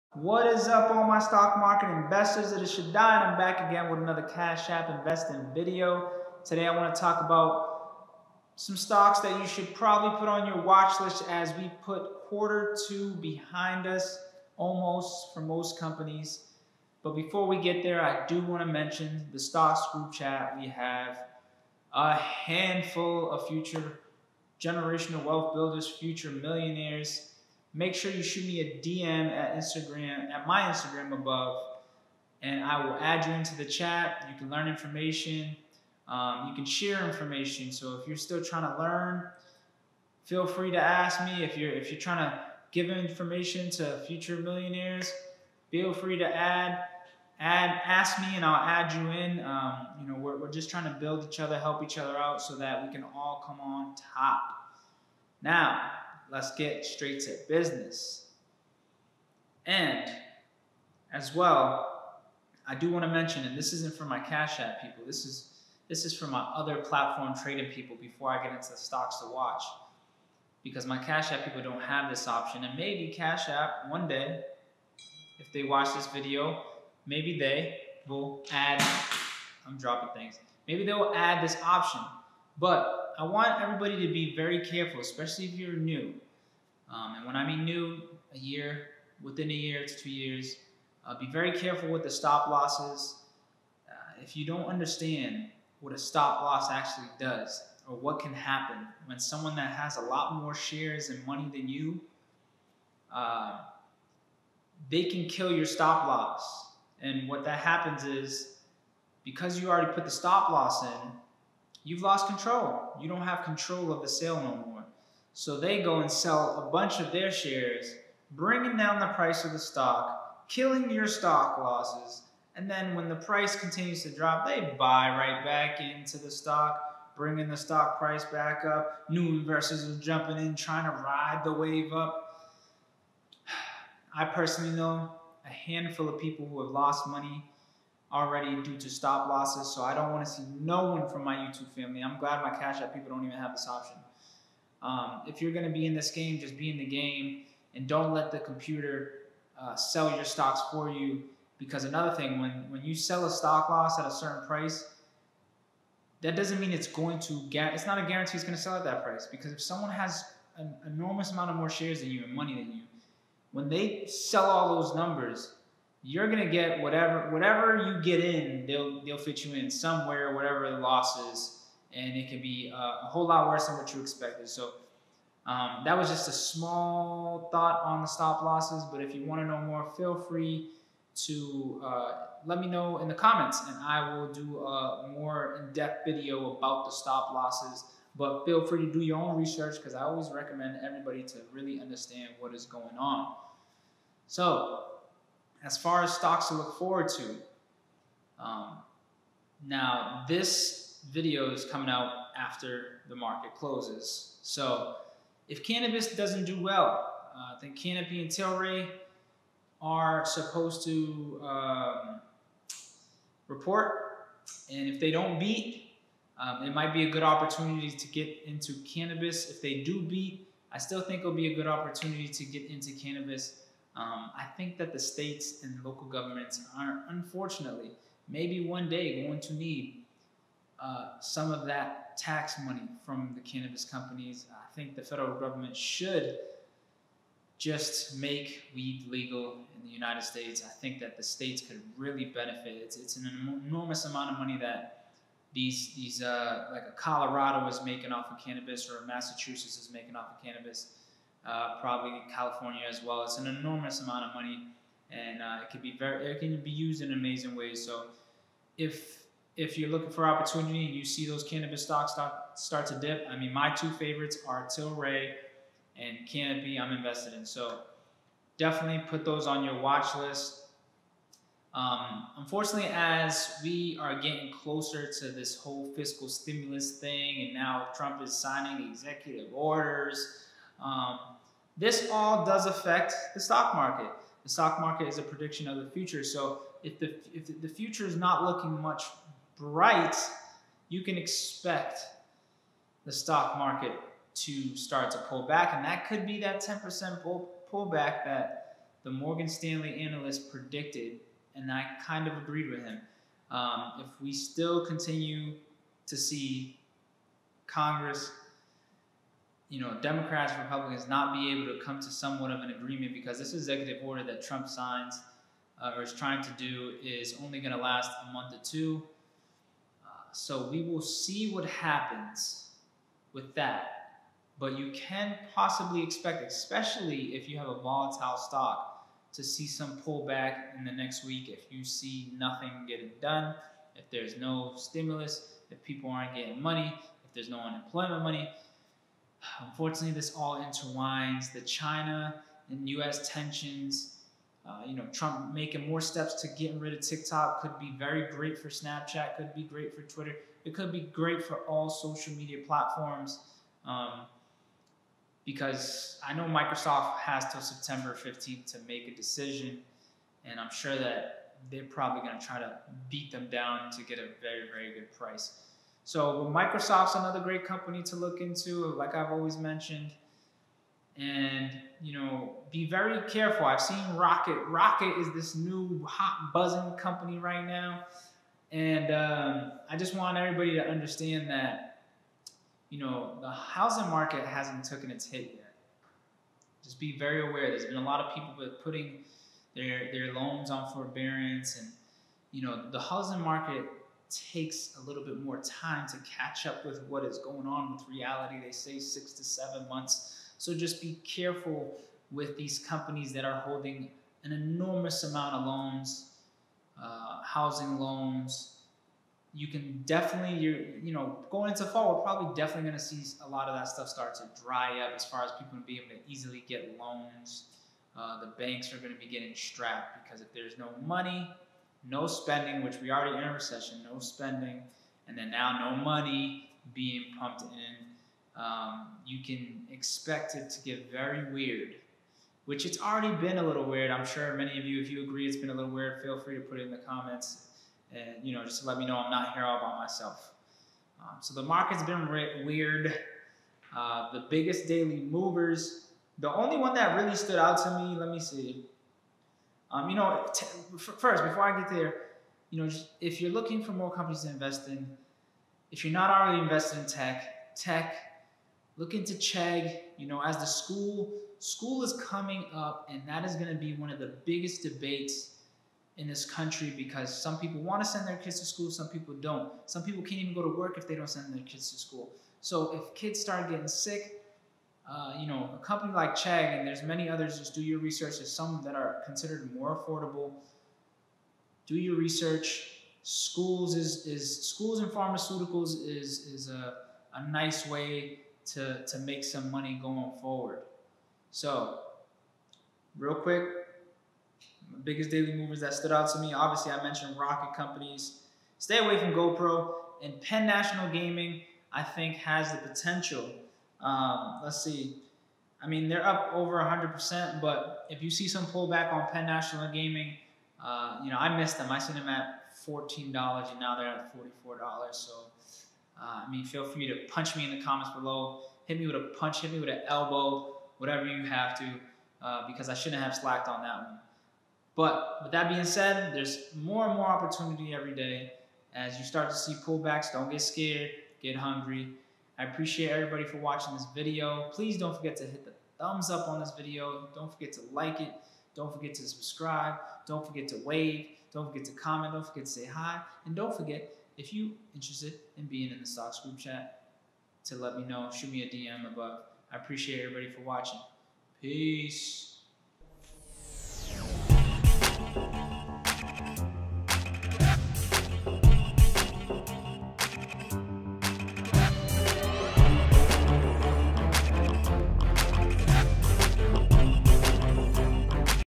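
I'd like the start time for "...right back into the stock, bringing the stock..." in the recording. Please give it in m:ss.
2:05.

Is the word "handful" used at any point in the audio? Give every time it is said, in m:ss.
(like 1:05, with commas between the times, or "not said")
0:22, 2:15.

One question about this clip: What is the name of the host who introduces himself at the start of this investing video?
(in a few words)
Shaddai.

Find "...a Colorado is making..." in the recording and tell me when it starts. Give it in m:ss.
4:06.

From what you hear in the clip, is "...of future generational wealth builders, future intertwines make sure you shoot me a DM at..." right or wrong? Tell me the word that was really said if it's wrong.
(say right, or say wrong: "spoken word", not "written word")
wrong: "millionaires", not "intertwines".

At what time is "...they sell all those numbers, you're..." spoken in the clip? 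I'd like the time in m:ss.
2:43.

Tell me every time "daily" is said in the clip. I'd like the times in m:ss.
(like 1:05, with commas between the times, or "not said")
7:24, 8:15.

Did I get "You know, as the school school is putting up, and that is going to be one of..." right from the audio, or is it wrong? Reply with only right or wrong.
wrong.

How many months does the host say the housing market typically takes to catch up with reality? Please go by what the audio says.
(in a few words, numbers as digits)
6 to 7 months.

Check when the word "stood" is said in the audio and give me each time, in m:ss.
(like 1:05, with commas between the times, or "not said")
7:27, 8:15.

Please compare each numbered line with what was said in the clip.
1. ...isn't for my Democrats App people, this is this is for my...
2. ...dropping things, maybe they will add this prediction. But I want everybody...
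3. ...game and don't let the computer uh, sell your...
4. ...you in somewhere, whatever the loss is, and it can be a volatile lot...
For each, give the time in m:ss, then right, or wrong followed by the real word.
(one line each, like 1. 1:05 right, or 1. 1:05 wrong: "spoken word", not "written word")
1. 1:03 wrong: "Cash", not "Democrats"
2. 1:19 wrong: "option", not "prediction"
3. 2:26 right
4. 2:49 wrong: "whole", not "volatile".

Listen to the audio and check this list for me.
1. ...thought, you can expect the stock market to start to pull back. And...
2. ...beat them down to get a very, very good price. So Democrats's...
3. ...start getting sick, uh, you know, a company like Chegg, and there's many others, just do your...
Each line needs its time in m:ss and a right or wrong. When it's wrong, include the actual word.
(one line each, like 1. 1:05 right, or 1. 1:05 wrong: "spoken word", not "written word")
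1. 4:49 wrong: "bright", not "thought"
2. 6:03 wrong: "Microsoft", not "Democrats"
3. 7:53 right.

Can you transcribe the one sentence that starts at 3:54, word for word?
I think the federal government should just make weed legal in the United States.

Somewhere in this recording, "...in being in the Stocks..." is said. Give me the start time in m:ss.
9:05.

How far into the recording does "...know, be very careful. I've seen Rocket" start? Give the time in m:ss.
6:12.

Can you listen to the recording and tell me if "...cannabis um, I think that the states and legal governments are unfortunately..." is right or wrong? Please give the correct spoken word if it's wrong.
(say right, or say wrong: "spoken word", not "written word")
wrong: "local", not "legal".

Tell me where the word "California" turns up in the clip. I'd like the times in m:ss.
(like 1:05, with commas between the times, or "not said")
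4:12.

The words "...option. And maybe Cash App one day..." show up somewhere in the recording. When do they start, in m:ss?
1:12.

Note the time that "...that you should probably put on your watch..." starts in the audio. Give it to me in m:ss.
0:09.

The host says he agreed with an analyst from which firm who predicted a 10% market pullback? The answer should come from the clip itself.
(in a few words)
Morgan Stanley.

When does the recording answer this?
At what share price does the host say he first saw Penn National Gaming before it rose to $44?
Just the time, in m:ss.
8:32.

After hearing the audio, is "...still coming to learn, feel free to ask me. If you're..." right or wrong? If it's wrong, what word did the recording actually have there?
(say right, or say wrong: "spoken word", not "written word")
wrong: "trying", not "coming".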